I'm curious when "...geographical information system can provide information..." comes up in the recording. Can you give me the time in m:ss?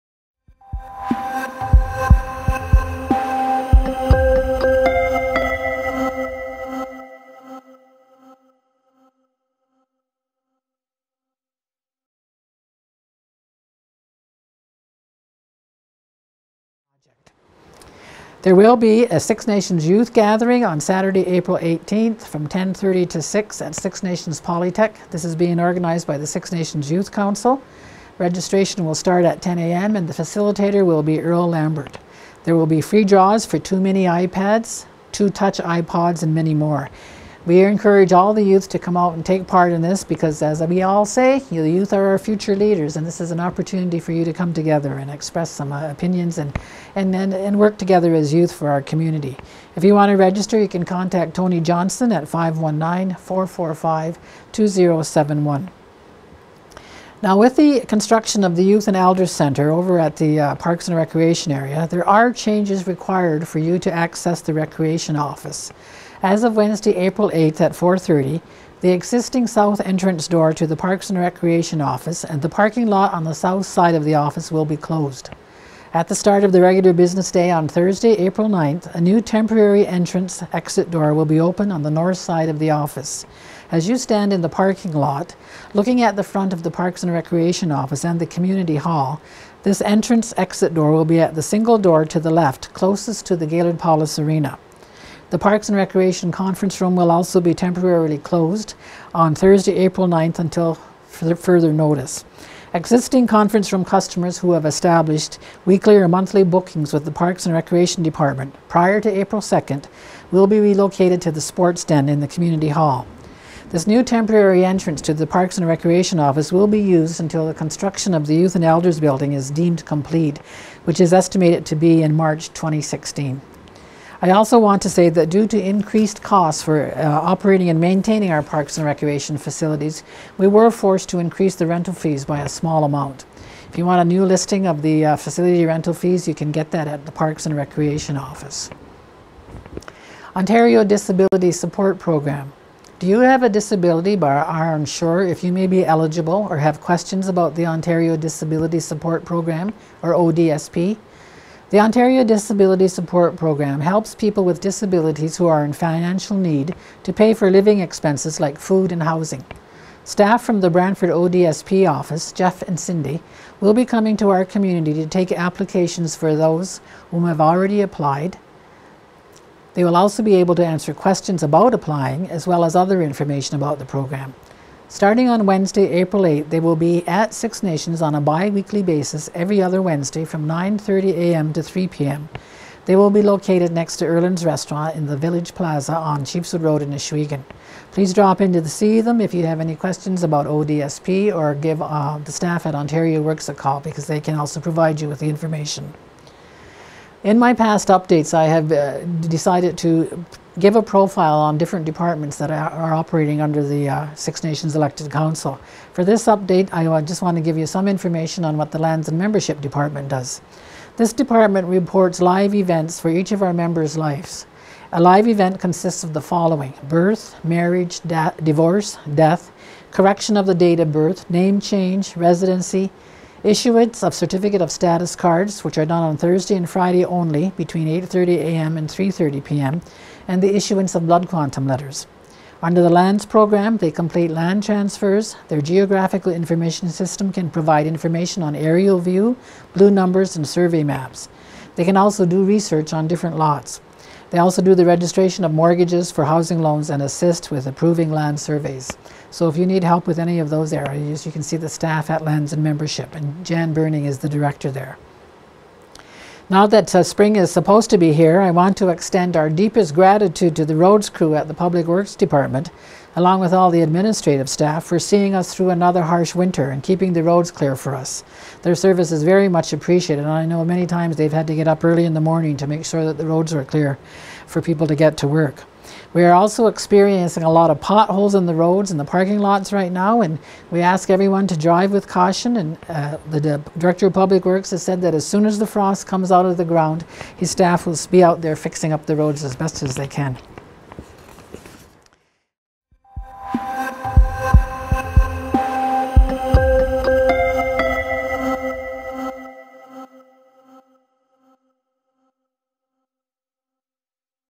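3:55.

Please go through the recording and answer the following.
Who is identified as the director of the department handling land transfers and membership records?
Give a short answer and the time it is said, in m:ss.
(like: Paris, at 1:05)
Jan Burning, at 4:13.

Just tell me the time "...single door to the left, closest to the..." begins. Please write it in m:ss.
1:31.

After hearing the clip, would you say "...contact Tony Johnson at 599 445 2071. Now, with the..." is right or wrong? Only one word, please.
wrong.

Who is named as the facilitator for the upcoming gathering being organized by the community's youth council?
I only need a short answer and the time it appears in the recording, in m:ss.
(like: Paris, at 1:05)
Earl Lambert, at 0:31.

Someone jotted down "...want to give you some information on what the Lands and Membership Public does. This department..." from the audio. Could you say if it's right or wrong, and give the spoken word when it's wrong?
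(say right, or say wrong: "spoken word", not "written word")
wrong: "Department", not "Public".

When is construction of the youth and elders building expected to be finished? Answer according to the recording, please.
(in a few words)
March 2016.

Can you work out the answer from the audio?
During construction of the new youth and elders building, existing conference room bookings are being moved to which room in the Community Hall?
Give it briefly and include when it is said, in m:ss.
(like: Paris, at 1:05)
sports den, at 1:51.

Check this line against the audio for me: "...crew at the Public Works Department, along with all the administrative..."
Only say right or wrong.
right.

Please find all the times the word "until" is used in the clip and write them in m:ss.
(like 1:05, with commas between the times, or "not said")
1:40, 1:57.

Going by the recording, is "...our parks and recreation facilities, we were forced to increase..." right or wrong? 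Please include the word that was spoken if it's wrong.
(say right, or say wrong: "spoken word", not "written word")
right.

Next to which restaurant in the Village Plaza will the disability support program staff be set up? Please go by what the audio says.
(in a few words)
Erland's Restaurant.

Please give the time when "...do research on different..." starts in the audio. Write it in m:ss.
4:02.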